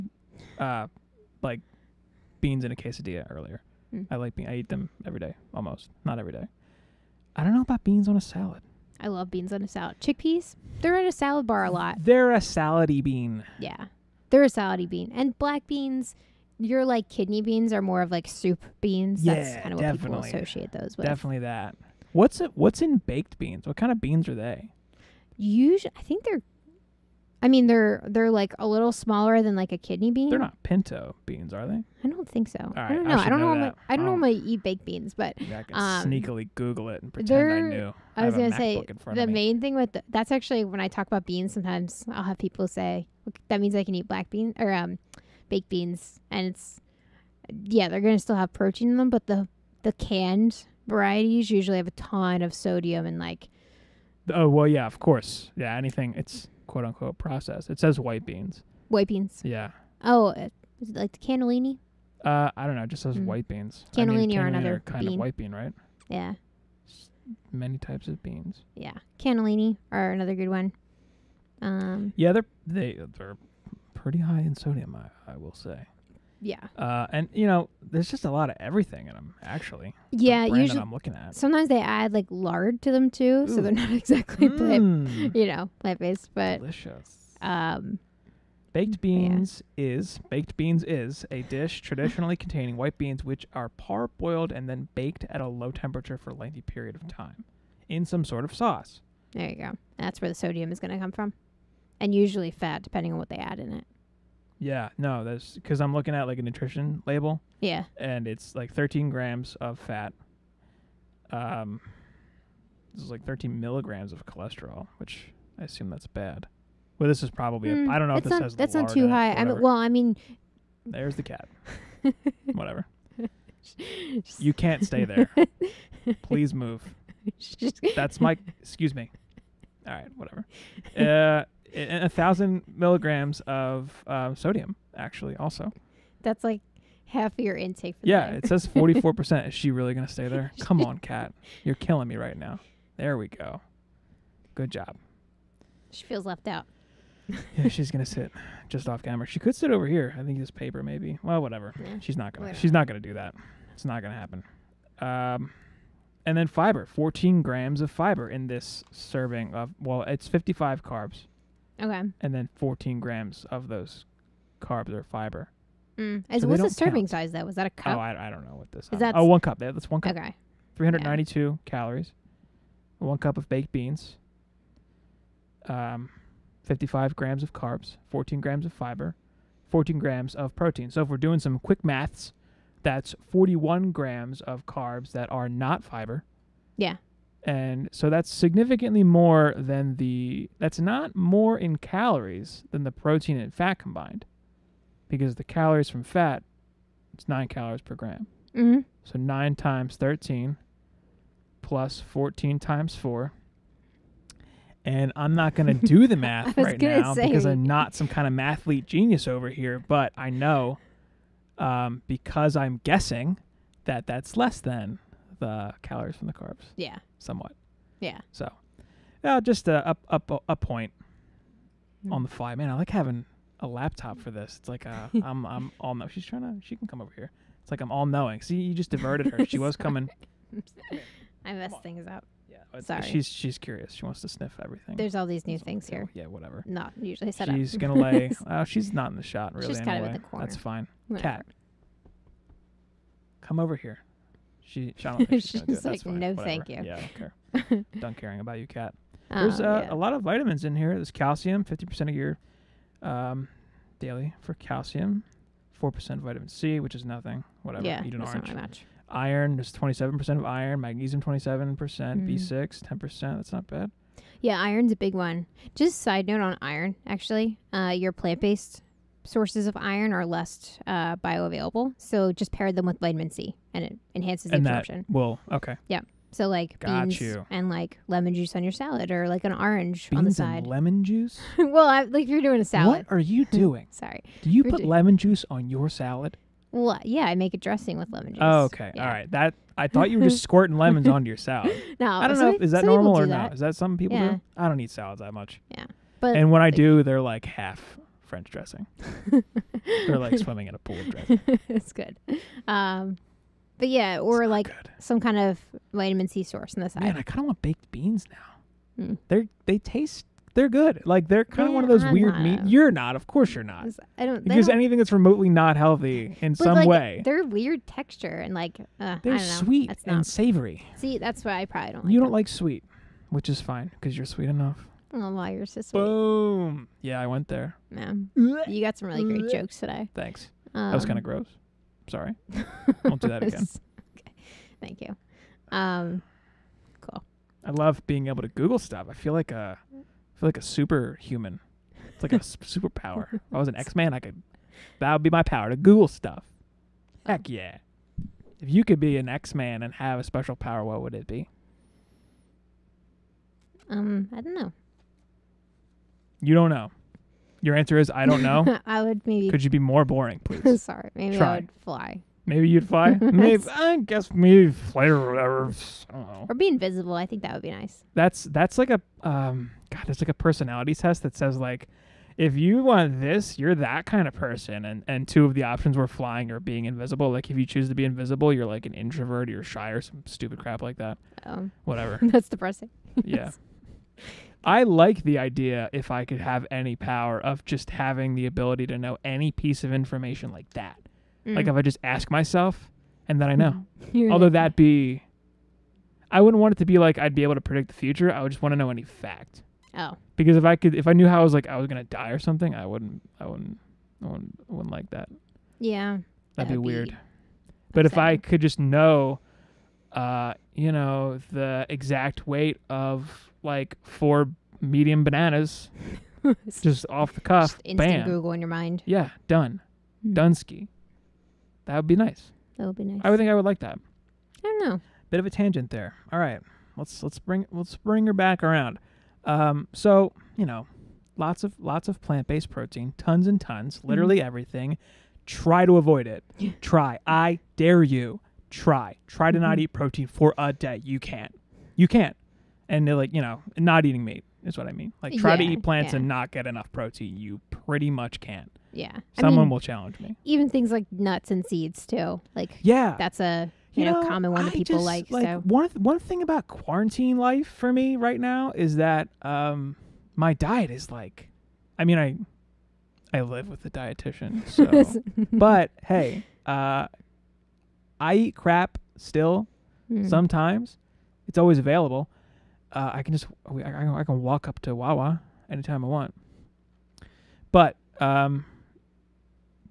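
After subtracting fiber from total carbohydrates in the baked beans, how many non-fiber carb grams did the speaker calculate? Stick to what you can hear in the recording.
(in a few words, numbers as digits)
41 grams.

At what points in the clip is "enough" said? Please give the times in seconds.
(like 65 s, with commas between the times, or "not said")
324 s, 446 s.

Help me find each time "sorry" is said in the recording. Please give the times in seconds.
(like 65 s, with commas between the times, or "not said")
232 s, 283 s, 332 s, 360 s.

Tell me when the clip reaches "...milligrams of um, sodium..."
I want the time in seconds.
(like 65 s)
132 s.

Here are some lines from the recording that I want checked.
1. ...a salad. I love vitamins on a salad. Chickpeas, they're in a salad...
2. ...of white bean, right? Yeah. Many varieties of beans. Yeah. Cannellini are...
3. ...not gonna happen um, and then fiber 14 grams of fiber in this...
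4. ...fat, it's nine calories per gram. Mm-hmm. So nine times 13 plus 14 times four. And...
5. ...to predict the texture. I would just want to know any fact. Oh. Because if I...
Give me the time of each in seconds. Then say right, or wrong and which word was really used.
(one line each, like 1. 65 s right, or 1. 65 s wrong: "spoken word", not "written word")
1. 8 s wrong: "beans", not "vitamins"
2. 65 s wrong: "types", not "varieties"
3. 153 s right
4. 196 s right
5. 397 s wrong: "future", not "texture".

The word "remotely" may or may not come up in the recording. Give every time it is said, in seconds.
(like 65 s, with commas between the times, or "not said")
315 s.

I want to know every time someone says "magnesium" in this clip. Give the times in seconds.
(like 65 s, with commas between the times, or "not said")
260 s.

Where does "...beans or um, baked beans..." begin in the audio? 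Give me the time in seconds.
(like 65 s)
44 s.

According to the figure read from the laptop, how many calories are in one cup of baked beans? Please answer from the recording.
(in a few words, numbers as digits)
392.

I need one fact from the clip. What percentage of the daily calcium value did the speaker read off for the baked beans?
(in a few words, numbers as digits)
50%.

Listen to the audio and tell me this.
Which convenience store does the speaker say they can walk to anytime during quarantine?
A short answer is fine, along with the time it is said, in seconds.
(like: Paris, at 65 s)
Wawa, at 474 s.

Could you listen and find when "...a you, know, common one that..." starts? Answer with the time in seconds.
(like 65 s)
453 s.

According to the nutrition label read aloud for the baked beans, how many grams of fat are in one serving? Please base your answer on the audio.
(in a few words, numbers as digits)
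13 grams.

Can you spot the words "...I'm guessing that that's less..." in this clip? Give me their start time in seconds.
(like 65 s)
212 s.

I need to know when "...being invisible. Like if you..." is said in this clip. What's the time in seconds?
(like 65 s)
376 s.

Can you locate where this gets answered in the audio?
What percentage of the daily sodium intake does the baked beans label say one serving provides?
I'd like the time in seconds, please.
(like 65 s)
138 s.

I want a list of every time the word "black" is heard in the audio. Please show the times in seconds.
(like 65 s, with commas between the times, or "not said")
15 s, 44 s.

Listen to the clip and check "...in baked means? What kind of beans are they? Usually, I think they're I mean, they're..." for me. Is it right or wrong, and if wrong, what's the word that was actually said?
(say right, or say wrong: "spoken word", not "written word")
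wrong: "beans", not "means".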